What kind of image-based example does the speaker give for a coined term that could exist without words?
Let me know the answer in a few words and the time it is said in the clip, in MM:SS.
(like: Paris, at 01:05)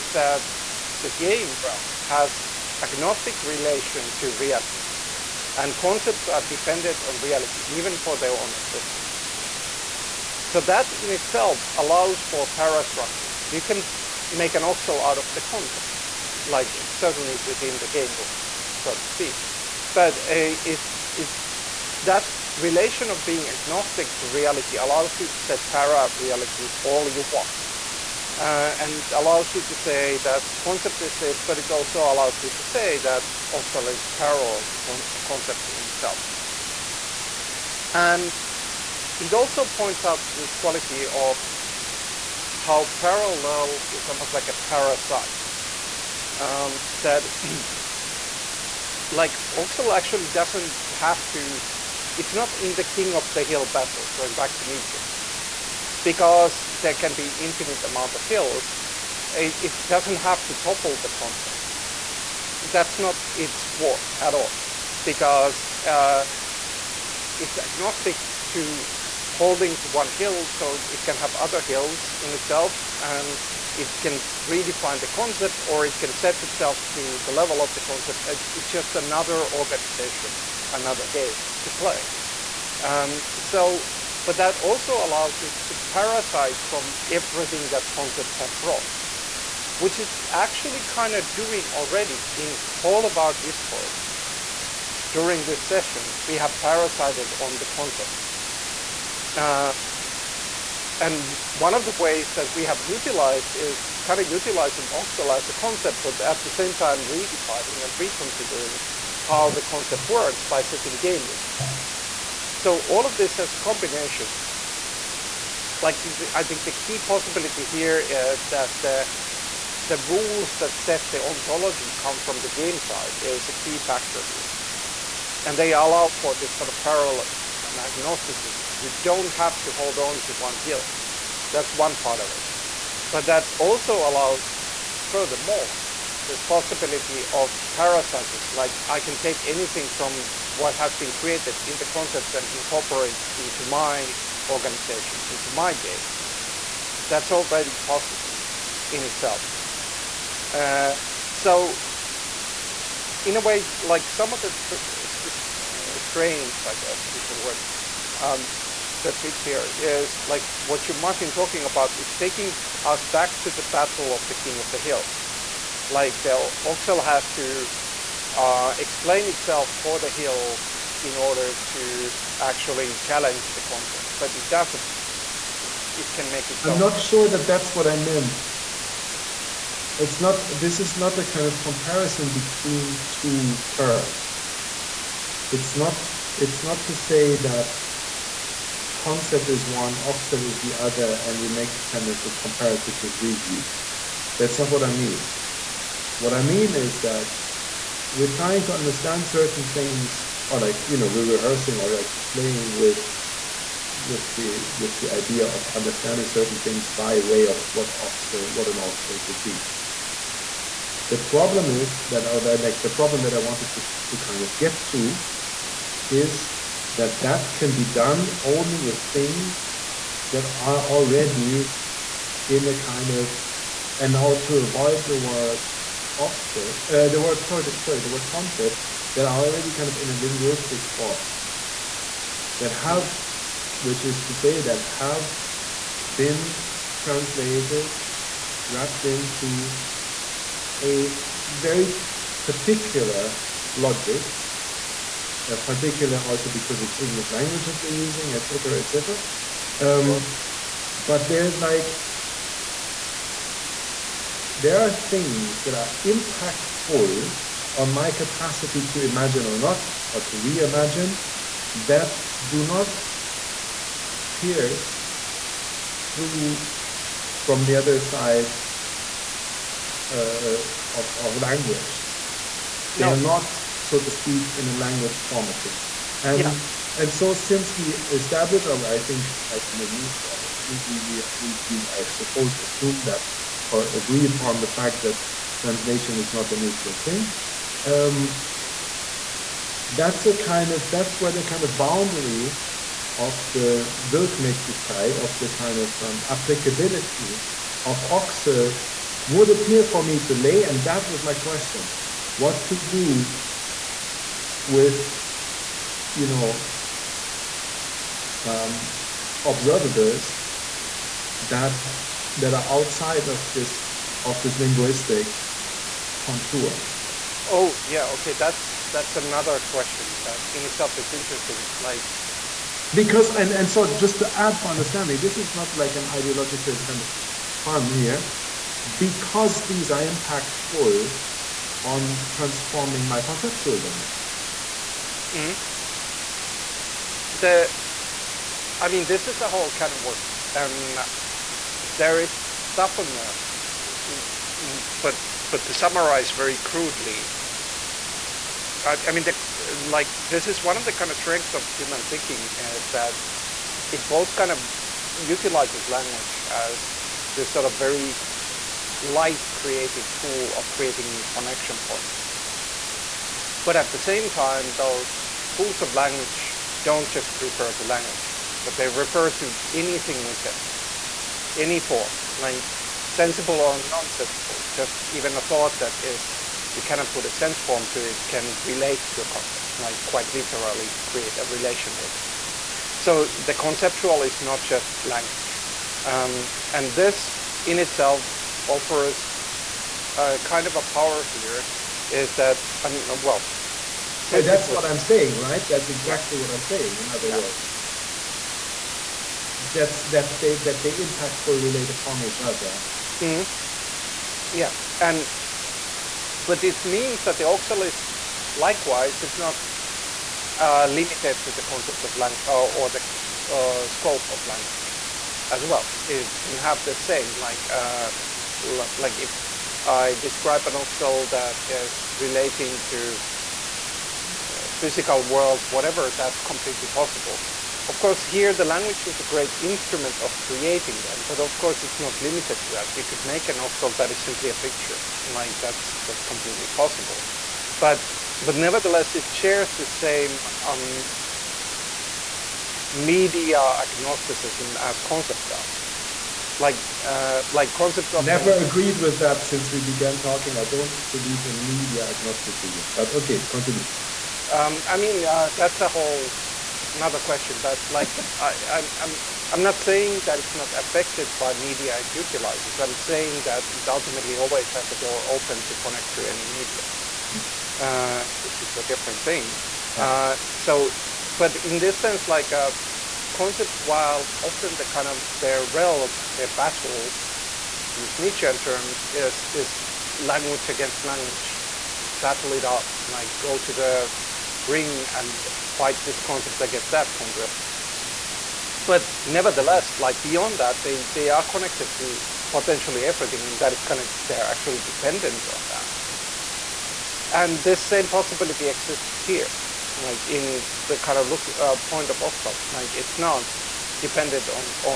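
a picture, at 07:14.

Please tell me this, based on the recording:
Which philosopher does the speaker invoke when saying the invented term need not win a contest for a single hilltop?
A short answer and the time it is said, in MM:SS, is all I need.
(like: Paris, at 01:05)
Nietzsche, at 00:54.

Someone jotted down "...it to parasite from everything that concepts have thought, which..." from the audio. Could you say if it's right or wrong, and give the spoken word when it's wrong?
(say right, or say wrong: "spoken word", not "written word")
wrong: "brought", not "thought".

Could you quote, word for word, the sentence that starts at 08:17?
And this same possibility exists here like in the kind of look uh, point of Oxel.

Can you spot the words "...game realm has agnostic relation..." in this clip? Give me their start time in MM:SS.
00:01.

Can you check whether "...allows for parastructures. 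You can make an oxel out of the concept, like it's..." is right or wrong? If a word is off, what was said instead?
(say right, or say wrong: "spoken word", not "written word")
right.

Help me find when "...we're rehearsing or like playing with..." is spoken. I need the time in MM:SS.
03:21.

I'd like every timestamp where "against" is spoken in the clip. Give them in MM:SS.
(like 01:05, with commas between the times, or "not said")
08:00, 08:06.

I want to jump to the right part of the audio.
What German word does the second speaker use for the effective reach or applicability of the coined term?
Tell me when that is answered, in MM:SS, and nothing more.
04:54.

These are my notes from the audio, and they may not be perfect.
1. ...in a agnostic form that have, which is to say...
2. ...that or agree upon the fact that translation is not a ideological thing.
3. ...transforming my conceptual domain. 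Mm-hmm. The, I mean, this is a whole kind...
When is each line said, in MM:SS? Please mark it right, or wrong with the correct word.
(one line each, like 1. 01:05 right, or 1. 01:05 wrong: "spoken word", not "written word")
1. 03:49 wrong: "linguistic", not "agnostic"
2. 04:43 wrong: "neutral", not "ideological"
3. 05:32 right.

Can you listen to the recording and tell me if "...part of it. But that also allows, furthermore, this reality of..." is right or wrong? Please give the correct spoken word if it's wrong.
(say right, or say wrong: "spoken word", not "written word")
wrong: "possibility", not "reality".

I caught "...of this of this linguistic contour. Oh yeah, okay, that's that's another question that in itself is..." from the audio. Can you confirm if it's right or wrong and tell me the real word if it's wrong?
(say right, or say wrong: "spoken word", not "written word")
right.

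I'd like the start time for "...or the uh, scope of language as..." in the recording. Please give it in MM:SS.
06:52.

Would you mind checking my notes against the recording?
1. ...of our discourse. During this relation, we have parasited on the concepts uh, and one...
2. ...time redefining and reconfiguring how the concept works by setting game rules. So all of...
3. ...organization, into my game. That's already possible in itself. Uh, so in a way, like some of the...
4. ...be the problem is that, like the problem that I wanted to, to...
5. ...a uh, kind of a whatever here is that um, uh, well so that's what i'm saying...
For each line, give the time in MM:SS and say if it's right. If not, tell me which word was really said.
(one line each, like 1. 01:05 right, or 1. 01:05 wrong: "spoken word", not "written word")
1. 01:33 wrong: "session", not "relation"
2. 01:46 right
3. 02:24 right
4. 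03:29 right
5. 06:30 wrong: "power", not "whatever".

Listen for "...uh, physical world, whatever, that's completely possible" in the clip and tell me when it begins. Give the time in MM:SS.
07:04.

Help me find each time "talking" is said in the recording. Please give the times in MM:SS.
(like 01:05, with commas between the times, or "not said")
02:41, 07:30.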